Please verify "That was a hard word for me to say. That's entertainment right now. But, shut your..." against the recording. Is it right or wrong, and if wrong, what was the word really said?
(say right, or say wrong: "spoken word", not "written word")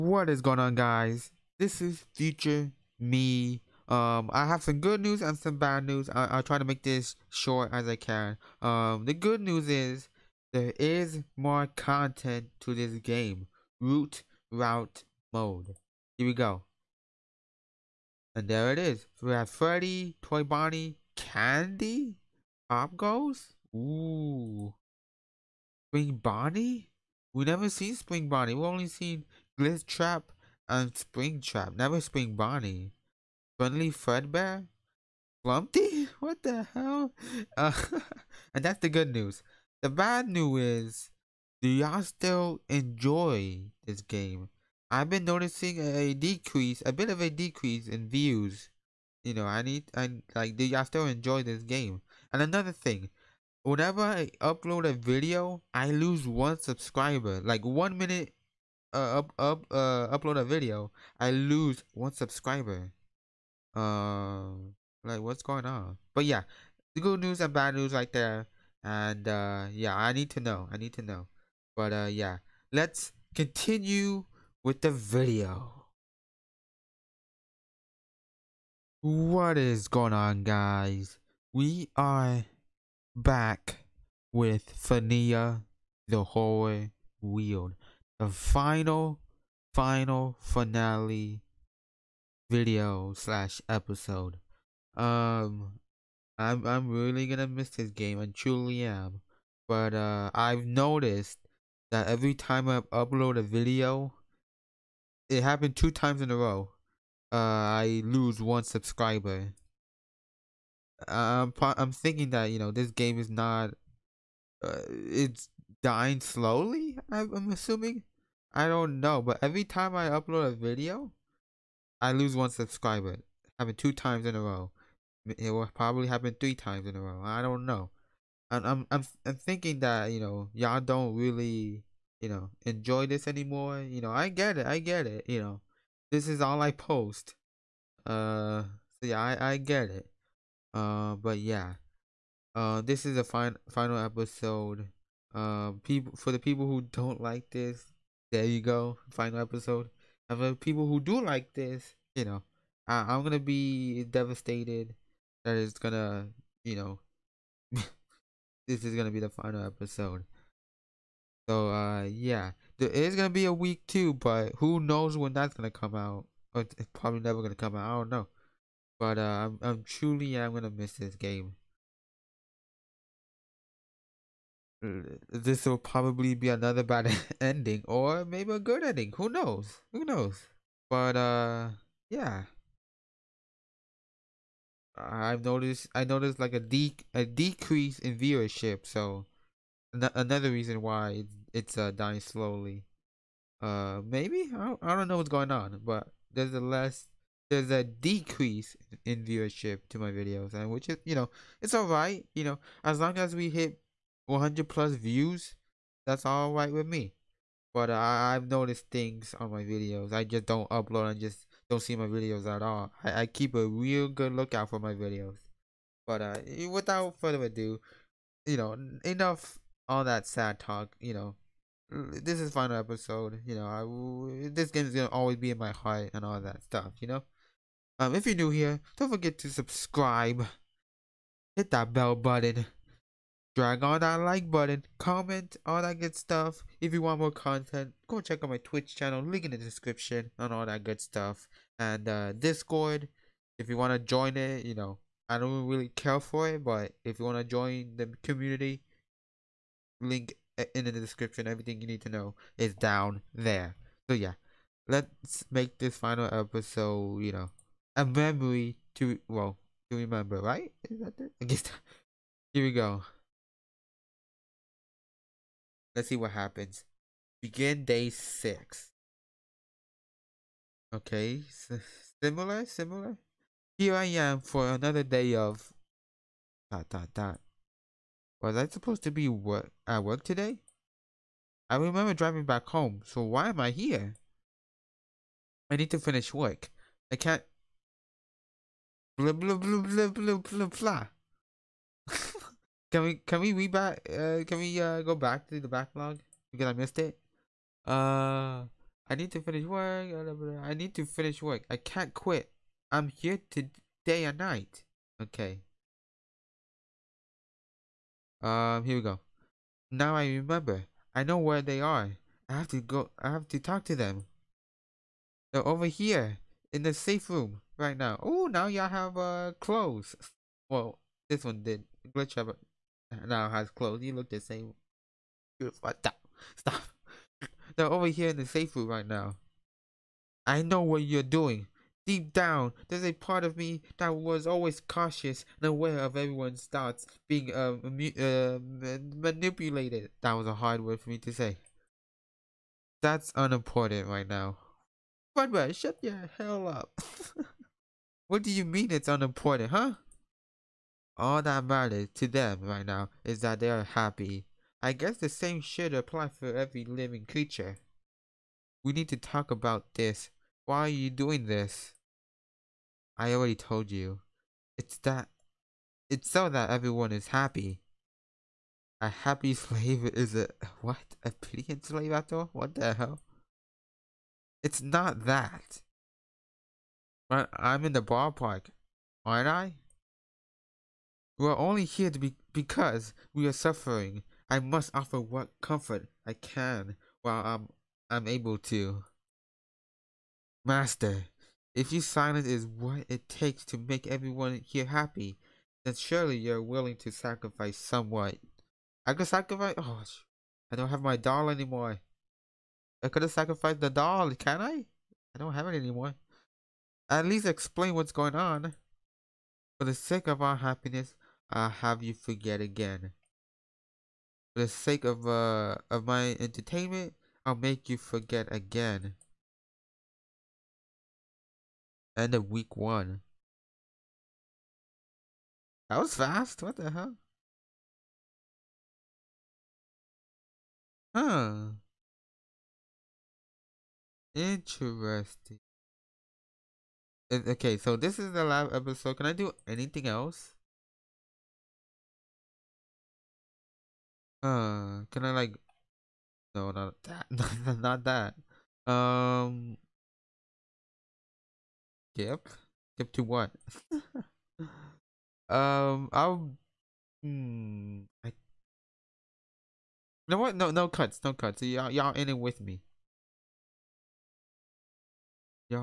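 wrong: "unimportant", not "entertainment".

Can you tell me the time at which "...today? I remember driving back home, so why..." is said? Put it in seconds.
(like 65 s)
280 s.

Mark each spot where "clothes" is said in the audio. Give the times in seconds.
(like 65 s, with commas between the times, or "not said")
319 s, 323 s.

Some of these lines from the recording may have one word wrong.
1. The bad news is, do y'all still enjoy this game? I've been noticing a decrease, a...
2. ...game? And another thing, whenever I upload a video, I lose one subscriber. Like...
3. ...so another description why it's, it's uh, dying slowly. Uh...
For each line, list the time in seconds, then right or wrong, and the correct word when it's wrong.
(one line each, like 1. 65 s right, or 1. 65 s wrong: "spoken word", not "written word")
1. 39 s right
2. 51 s right
3. 188 s wrong: "reason", not "description".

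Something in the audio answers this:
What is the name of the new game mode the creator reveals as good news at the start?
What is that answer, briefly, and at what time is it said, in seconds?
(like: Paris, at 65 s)
Root route mode, at 13 s.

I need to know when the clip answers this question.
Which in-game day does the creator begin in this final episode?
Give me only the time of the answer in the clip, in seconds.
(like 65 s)
267 s.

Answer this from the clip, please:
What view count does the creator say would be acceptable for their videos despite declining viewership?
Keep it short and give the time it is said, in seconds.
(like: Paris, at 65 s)
100 plus, at 204 s.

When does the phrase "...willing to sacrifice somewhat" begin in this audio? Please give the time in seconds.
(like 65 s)
396 s.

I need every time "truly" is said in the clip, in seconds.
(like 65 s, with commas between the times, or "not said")
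98 s, 169 s.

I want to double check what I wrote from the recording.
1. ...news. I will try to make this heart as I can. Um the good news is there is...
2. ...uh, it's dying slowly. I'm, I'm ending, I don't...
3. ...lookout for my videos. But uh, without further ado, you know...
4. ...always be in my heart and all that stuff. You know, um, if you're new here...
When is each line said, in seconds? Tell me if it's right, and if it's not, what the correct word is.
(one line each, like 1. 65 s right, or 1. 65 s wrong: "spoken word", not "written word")
1. 5 s wrong: "short", not "heart"
2. 114 s wrong: "assuming", not "ending"
3. 214 s right
4. 225 s right.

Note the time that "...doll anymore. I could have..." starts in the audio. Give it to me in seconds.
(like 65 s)
401 s.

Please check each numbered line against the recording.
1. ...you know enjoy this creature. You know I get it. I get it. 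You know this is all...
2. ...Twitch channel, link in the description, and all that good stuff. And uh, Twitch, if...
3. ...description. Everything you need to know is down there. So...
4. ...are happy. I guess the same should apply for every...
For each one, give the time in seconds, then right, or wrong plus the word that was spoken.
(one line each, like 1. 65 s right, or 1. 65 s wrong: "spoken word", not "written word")
1. 132 s wrong: "anymore", not "creature"
2. 238 s wrong: "Discord", not "Twitch"
3. 250 s right
4. 353 s right.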